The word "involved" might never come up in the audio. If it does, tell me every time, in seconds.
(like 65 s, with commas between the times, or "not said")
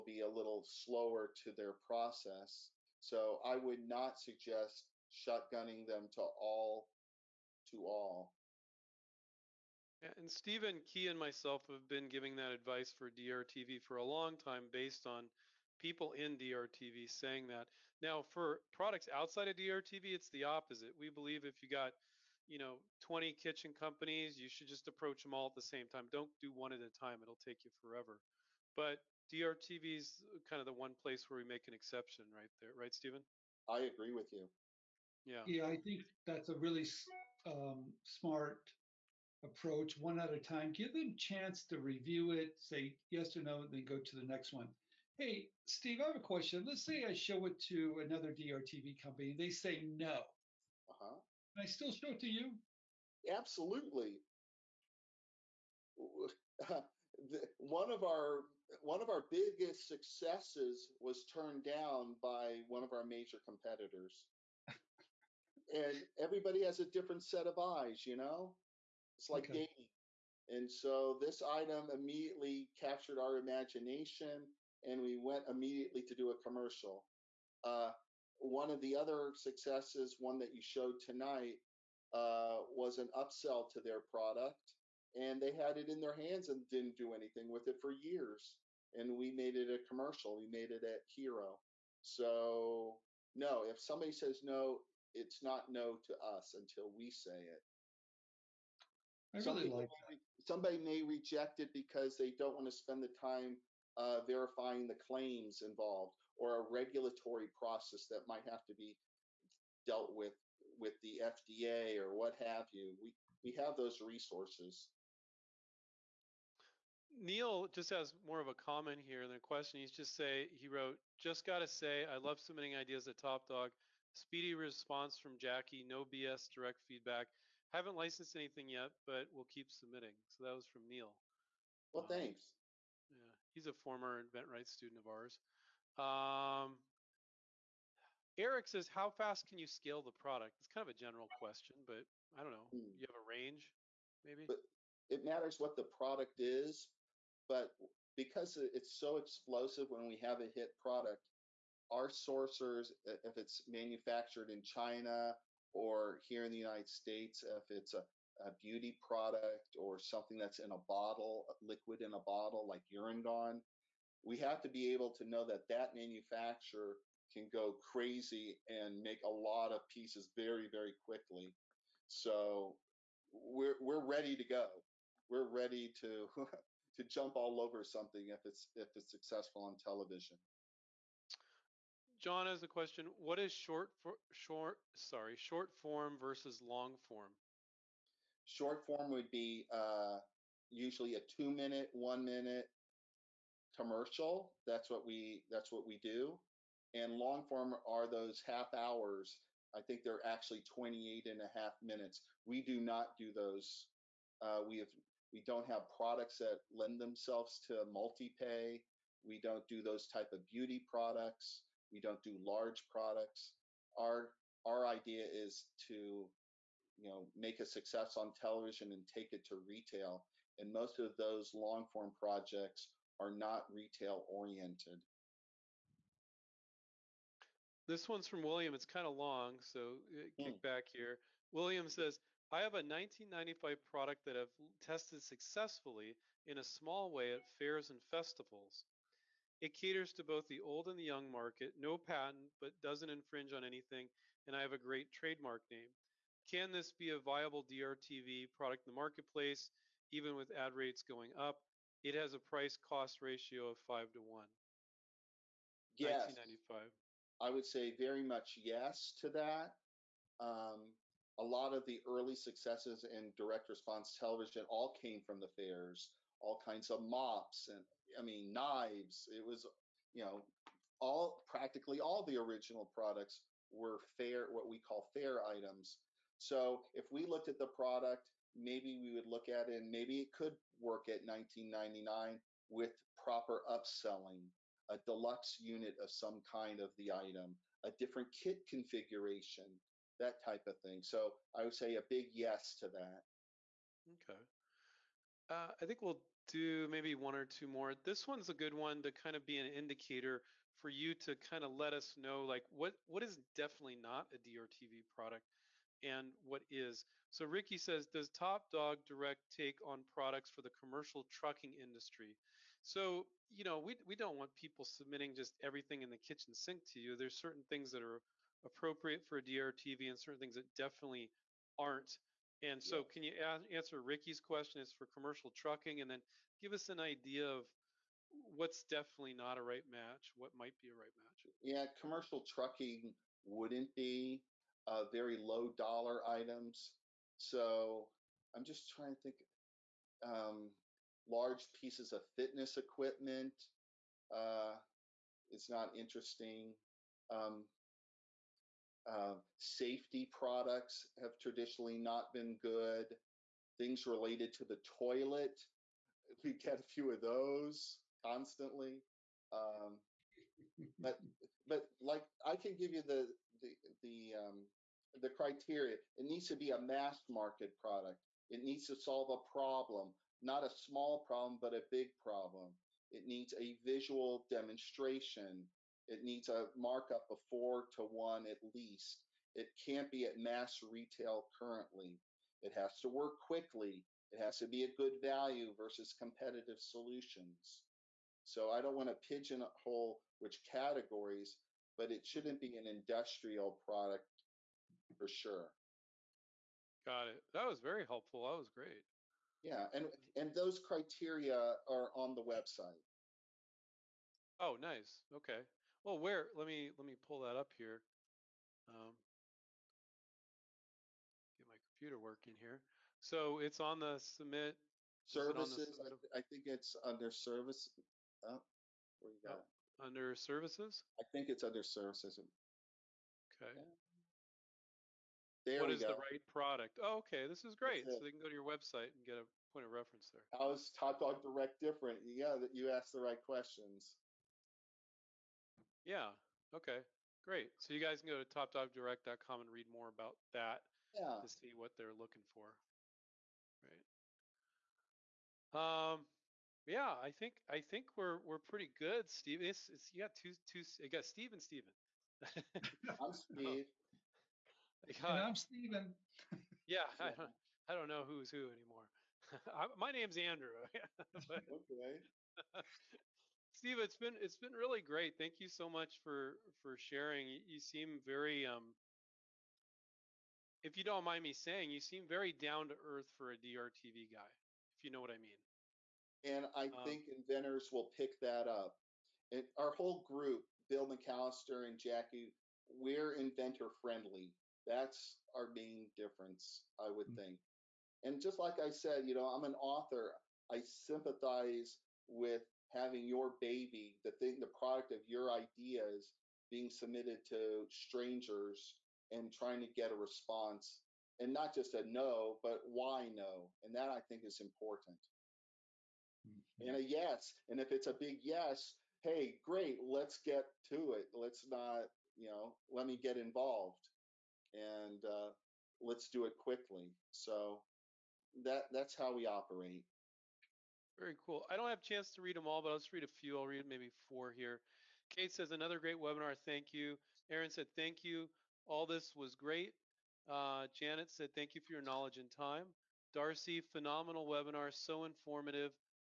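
105 s, 513 s.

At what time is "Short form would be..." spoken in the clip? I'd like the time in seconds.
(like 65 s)
188 s.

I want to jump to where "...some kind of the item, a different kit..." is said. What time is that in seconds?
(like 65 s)
286 s.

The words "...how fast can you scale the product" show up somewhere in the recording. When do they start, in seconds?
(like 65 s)
138 s.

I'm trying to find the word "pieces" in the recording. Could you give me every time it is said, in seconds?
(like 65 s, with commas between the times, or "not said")
169 s, 341 s.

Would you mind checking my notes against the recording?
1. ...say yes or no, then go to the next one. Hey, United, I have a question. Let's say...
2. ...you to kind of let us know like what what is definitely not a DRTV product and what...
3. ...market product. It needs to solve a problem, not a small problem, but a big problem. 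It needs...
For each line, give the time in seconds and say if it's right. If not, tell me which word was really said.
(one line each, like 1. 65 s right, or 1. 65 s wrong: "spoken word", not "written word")
1. 42 s wrong: "Steve", not "United"
2. 300 s right
3. 367 s right.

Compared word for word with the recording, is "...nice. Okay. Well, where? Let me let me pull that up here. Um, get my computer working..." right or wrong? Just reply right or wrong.
right.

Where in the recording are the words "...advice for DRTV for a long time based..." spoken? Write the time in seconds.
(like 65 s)
12 s.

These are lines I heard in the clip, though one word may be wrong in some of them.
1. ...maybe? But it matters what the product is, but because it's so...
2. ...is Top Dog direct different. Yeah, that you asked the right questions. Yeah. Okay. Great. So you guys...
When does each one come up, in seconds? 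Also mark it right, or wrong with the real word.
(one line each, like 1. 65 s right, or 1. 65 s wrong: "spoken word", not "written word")
1. 144 s right
2. 430 s right.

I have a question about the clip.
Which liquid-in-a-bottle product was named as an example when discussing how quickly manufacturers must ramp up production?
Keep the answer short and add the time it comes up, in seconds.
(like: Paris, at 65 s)
Urine Gone, at 162 s.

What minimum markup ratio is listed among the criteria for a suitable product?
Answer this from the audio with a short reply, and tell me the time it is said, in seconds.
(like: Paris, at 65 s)
4 to 1, at 377 s.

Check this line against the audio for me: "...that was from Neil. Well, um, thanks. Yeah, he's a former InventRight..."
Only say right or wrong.
right.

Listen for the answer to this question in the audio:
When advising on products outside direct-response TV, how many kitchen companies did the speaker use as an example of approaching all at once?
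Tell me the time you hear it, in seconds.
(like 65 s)
23 s.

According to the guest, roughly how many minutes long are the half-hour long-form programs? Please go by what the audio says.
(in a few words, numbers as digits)
28 and a half.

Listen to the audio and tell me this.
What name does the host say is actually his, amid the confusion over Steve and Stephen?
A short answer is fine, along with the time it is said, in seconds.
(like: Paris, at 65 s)
Andrew, at 460 s.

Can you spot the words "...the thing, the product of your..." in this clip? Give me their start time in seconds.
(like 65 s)
494 s.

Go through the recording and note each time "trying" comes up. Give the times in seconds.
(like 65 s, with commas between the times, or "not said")
338 s, 499 s.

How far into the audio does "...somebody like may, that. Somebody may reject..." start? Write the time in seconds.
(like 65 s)
99 s.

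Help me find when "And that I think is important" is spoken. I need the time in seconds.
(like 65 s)
503 s.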